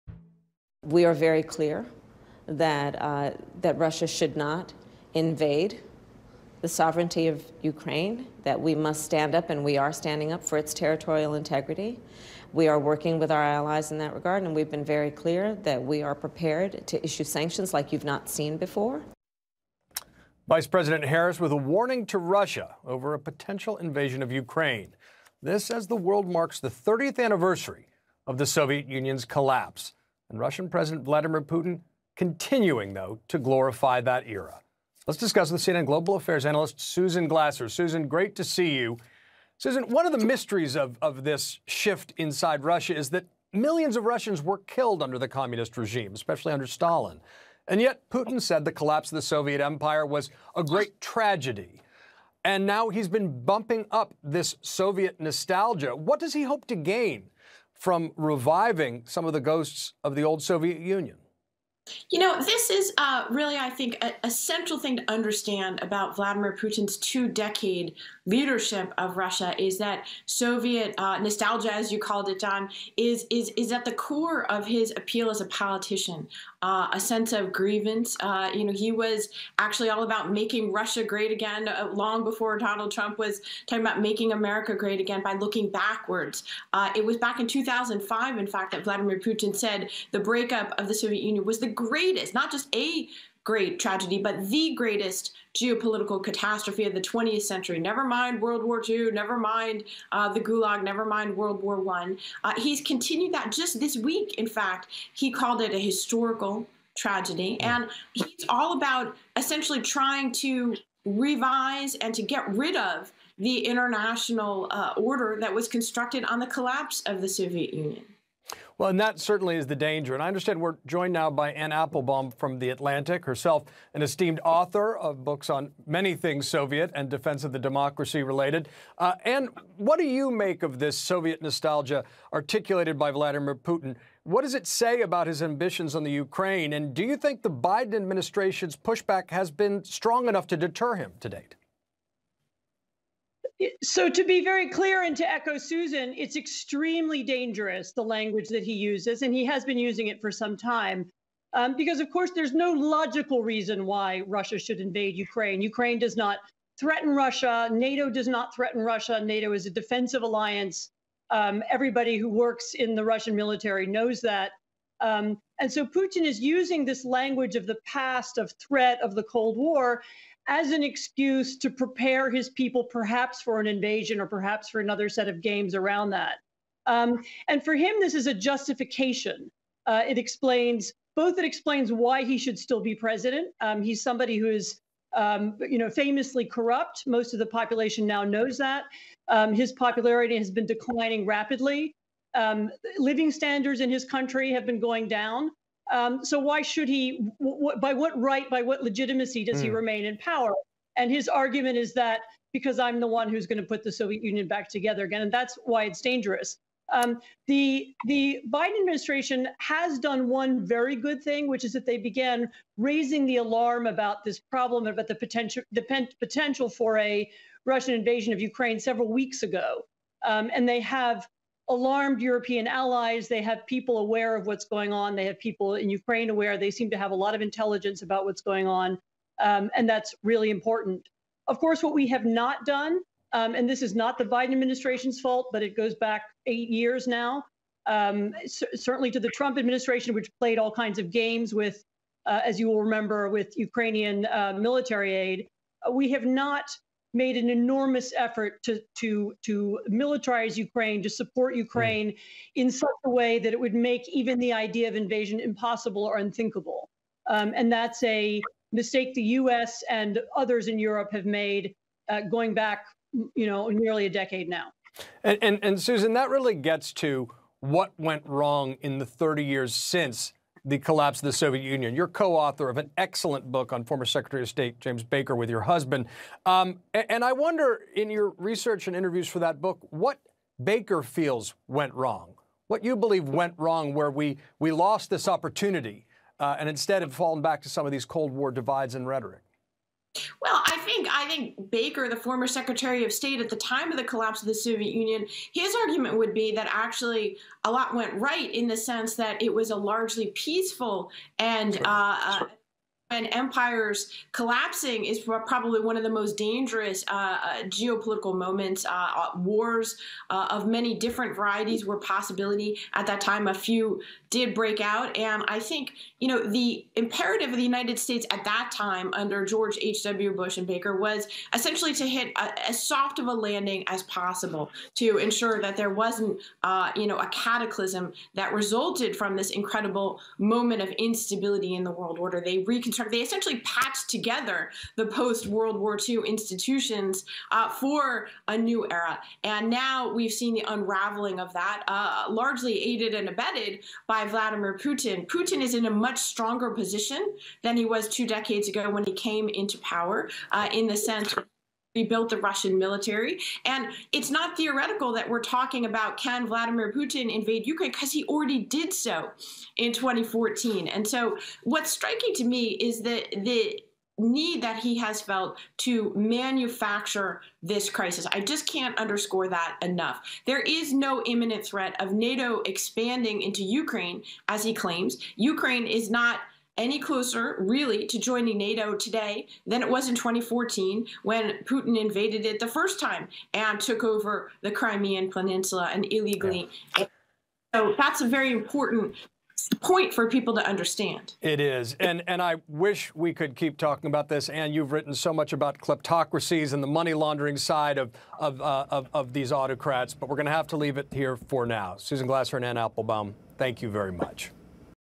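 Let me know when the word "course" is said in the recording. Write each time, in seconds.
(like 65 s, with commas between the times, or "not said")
152 s, 231 s.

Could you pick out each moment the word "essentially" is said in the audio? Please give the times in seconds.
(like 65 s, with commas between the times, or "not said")
109 s, 321 s, 333 s.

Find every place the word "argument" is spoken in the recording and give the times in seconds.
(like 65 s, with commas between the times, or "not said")
201 s, 295 s.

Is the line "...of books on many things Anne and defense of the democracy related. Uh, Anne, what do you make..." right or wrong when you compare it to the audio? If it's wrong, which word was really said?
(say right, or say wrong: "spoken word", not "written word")
wrong: "Soviet", not "Anne".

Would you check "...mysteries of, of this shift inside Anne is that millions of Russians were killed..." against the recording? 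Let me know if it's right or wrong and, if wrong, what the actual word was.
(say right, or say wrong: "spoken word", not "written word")
wrong: "Russia", not "Anne".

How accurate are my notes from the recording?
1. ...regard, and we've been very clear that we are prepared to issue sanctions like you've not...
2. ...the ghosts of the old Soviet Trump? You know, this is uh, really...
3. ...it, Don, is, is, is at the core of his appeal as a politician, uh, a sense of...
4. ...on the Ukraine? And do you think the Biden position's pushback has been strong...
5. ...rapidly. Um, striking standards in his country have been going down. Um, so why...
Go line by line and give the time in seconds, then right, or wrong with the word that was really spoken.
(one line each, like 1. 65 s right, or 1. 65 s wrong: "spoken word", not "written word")
1. 14 s right
2. 59 s wrong: "Union", not "Trump"
3. 72 s right
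4. 135 s wrong: "administration", not "position"
5. 191 s wrong: "living", not "striking".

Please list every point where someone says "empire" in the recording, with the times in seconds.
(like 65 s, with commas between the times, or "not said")
49 s, 303 s.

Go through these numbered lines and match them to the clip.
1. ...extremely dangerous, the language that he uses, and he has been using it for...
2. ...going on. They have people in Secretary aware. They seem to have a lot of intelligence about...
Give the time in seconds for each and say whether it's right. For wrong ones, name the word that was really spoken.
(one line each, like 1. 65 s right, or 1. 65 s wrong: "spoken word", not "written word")
1. 146 s right
2. 224 s wrong: "Ukraine", not "Secretary".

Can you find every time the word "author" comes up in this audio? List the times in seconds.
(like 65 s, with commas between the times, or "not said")
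124 s, 272 s.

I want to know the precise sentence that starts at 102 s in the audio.
Uh, he's continued that just this week, in fact.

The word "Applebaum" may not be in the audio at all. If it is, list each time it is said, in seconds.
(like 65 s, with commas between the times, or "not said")
121 s, 402 s.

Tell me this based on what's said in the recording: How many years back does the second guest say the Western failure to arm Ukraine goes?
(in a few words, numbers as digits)
8 years.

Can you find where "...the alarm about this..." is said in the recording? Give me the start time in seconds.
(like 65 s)
213 s.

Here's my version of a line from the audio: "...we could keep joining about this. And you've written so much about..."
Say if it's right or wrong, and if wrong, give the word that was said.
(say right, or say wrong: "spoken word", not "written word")
wrong: "talking", not "joining".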